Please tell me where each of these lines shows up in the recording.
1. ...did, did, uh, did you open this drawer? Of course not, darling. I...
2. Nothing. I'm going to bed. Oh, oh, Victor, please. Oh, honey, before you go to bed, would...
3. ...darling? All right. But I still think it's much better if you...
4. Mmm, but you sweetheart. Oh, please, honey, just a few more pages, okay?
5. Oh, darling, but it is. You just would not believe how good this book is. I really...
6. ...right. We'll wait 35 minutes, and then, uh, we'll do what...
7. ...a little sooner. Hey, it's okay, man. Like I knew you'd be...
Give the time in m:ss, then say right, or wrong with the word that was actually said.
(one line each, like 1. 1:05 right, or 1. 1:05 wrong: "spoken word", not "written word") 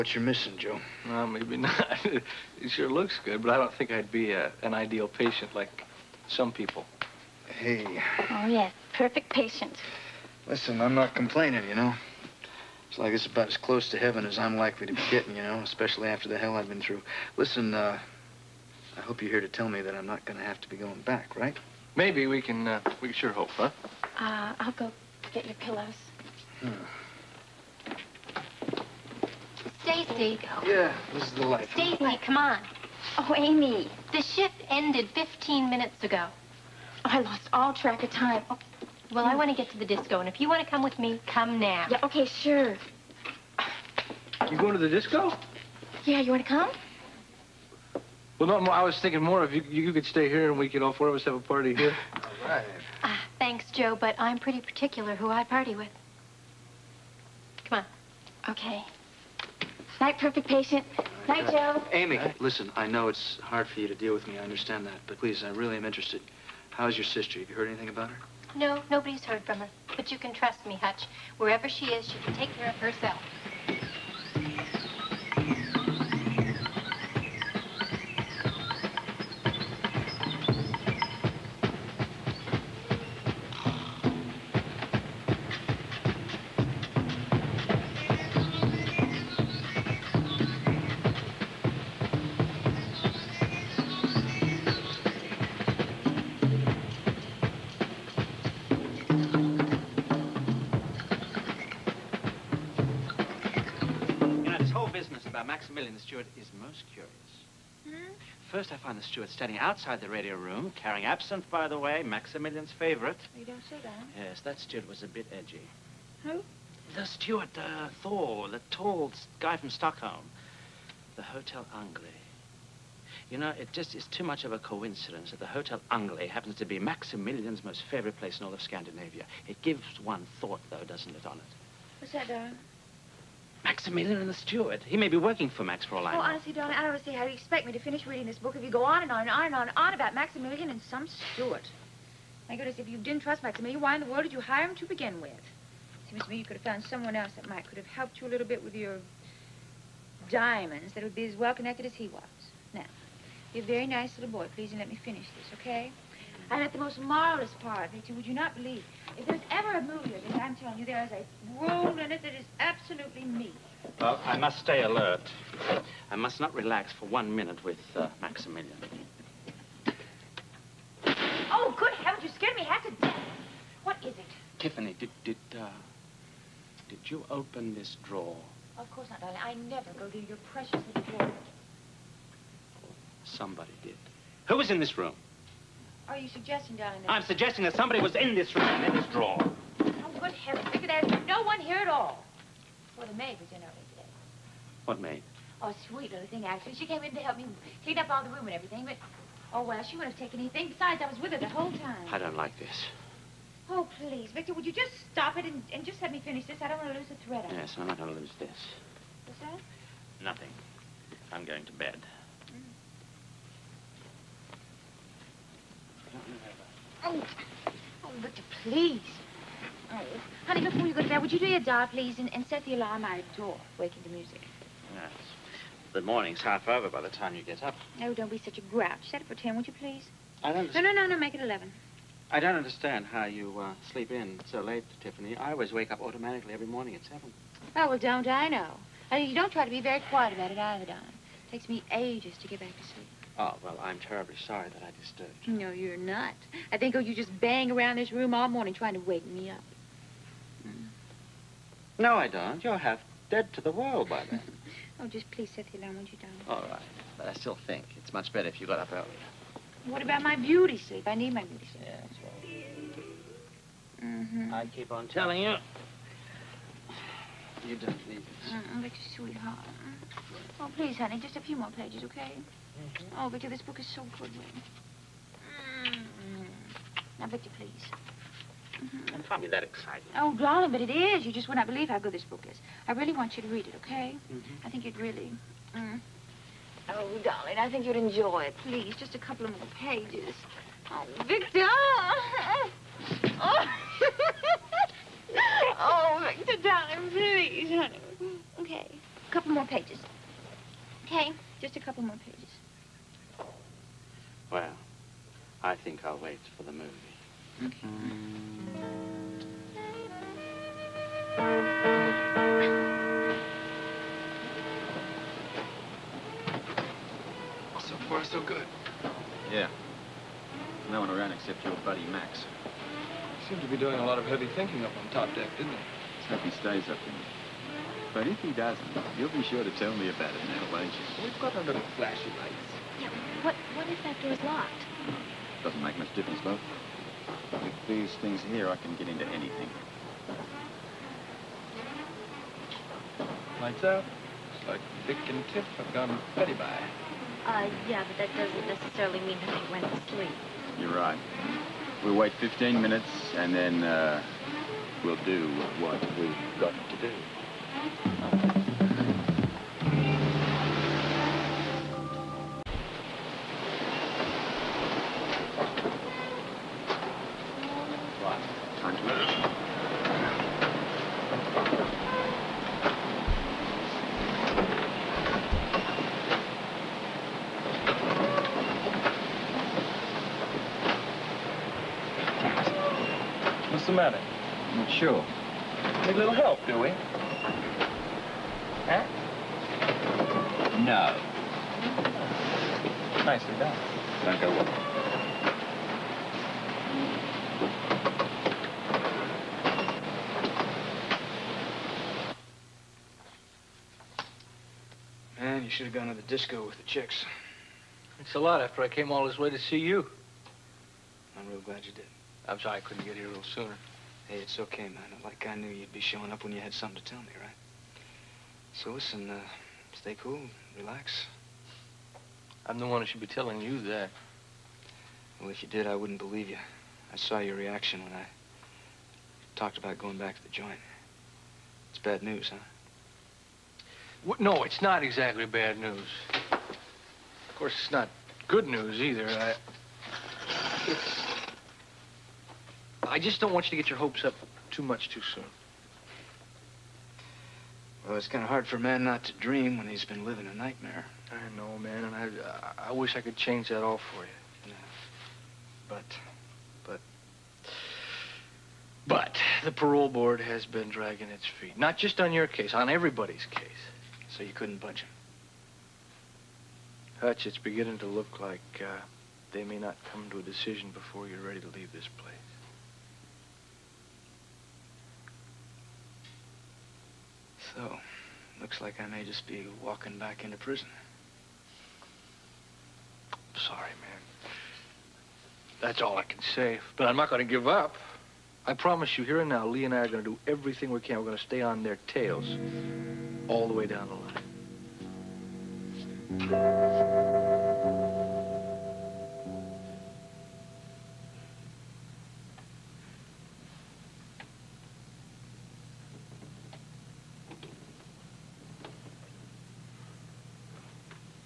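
1. 2:54 right
2. 3:30 right
3. 4:16 right
4. 4:28 right
5. 4:40 right
6. 5:50 wrong: "15", not "35"
7. 6:53 right.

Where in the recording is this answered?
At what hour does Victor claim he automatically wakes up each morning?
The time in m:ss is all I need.
3:57.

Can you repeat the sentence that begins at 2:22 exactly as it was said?
My goodness, if you didn't trust Maximilian, why in the world did you hire him to begin with?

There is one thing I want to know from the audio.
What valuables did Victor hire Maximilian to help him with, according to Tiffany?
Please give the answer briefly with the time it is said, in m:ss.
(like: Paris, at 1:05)
diamonds, at 2:30.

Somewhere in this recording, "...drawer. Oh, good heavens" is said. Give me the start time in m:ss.
3:09.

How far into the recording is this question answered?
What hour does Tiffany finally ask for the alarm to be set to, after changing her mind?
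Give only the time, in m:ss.
3:51.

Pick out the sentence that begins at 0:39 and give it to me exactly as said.
Well, I want to get to the disco, and if you want to come with me, come now.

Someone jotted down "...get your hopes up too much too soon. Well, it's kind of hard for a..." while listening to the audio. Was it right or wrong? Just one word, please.
right.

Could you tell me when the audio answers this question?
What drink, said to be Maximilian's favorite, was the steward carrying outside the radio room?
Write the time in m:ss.
1:51.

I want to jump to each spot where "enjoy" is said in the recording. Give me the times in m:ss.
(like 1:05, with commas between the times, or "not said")
4:48.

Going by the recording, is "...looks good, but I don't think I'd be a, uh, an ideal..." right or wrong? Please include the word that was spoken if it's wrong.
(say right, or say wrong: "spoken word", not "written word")
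right.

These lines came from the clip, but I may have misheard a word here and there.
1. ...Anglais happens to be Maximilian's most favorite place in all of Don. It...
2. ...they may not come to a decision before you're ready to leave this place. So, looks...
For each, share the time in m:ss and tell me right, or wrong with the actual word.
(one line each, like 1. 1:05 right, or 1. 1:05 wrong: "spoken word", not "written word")
1. 2:05 wrong: "Scandinavia", not "Don"
2. 7:49 right.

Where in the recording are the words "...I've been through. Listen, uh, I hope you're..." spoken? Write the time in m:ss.
0:16.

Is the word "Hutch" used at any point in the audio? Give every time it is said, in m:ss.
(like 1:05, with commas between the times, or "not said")
1:10, 7:47.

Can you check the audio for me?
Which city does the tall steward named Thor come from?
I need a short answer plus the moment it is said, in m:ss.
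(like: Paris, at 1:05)
Stockholm, at 1:59.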